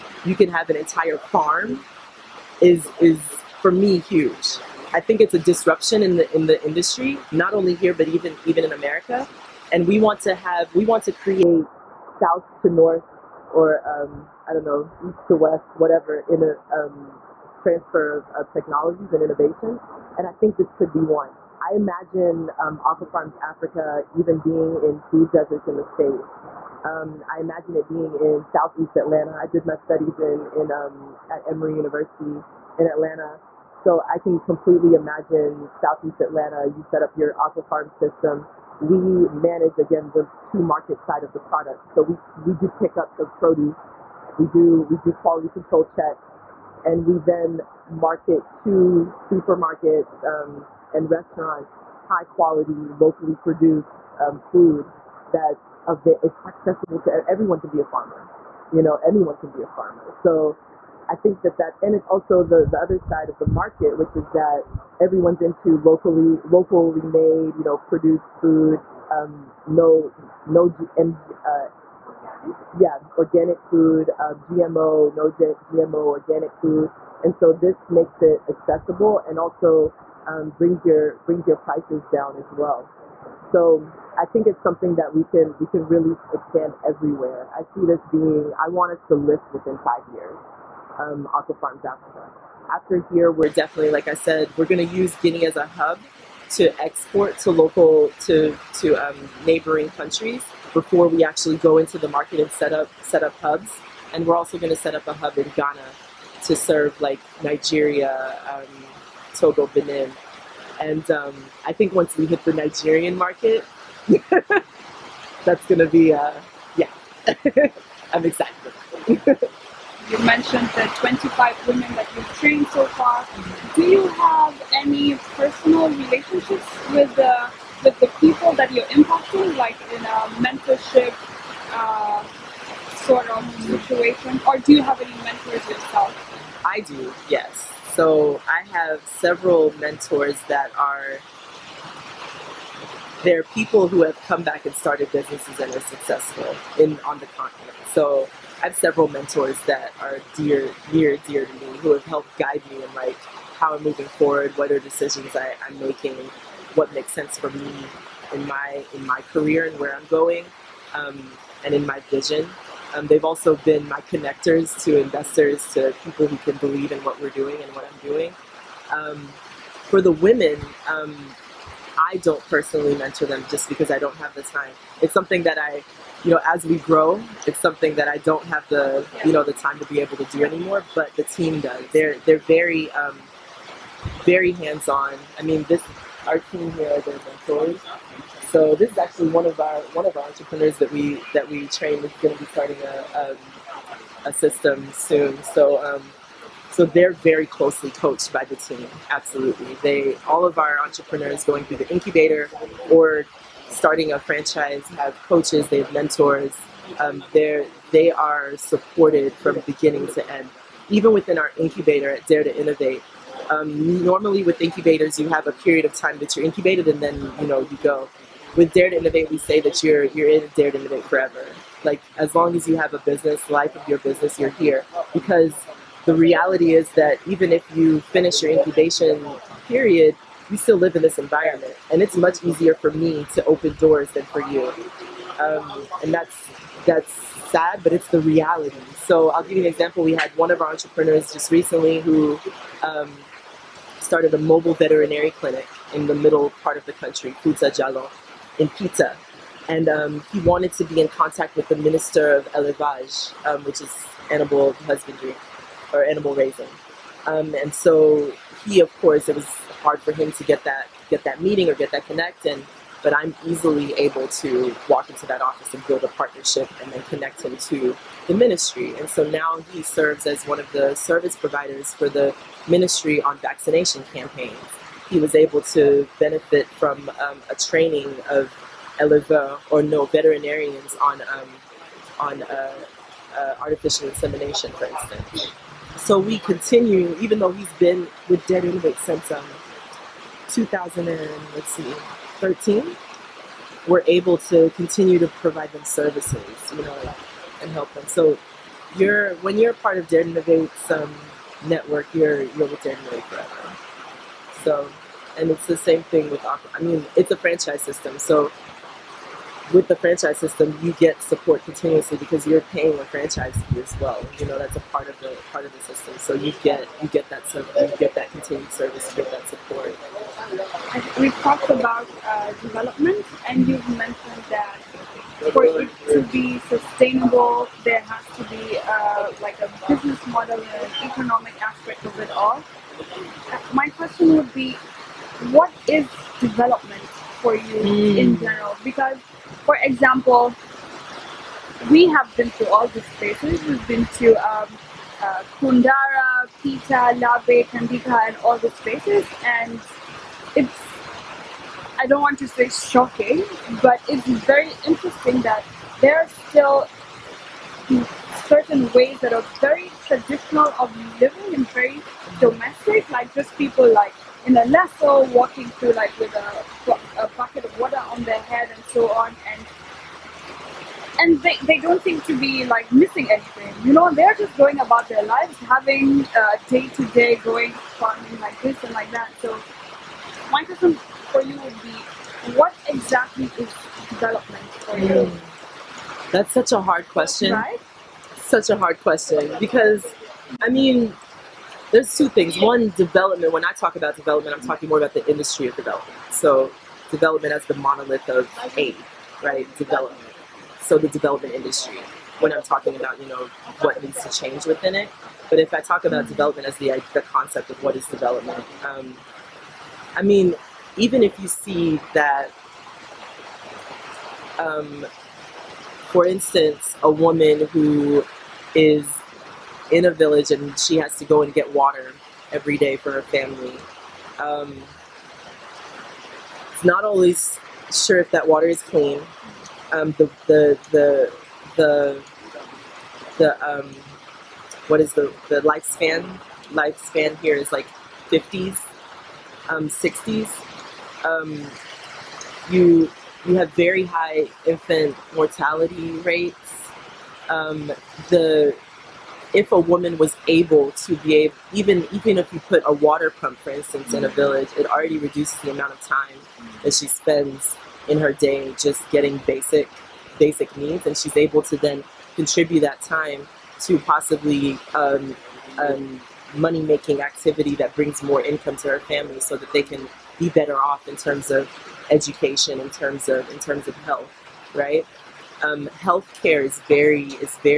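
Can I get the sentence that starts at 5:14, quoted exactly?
You know that's a part of the part of the system.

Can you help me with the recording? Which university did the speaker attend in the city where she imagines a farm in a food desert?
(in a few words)
Emory University.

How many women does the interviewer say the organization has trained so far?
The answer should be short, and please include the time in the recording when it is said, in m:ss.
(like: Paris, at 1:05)
25, at 2:00.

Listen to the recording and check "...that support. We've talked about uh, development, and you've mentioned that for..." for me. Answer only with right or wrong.
right.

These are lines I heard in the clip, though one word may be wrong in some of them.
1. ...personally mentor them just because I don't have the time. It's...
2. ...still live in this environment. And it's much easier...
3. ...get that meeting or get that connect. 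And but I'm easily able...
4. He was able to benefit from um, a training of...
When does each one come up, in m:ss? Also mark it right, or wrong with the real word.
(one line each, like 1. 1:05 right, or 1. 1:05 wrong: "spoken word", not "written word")
1. 2:52 right
2. 3:50 right
3. 4:21 right
4. 4:35 right.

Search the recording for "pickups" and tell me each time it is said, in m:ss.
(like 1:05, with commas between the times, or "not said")
0:42.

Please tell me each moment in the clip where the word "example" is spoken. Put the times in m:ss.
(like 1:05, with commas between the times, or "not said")
3:59, 5:39.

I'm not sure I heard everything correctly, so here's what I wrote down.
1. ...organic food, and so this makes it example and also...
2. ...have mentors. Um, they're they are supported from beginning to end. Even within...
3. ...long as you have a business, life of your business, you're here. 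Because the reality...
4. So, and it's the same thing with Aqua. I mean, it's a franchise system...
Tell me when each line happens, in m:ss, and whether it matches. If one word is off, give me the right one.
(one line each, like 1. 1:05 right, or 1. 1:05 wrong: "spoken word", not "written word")
1. 1:16 wrong: "accessible", not "example"
2. 3:25 right
3. 3:42 right
4. 5:04 right.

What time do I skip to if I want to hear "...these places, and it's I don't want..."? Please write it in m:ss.
5:48.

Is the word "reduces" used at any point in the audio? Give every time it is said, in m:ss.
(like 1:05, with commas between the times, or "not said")
7:35.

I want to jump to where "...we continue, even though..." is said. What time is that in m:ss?
4:46.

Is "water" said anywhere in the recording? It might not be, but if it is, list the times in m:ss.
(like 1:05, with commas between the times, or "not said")
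6:07, 7:01, 7:08, 7:32.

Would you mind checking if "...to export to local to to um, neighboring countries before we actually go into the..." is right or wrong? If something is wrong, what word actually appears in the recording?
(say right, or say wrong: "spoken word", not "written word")
right.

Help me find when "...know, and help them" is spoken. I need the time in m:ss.
4:56.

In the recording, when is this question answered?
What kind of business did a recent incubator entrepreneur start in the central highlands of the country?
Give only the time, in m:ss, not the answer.
4:04.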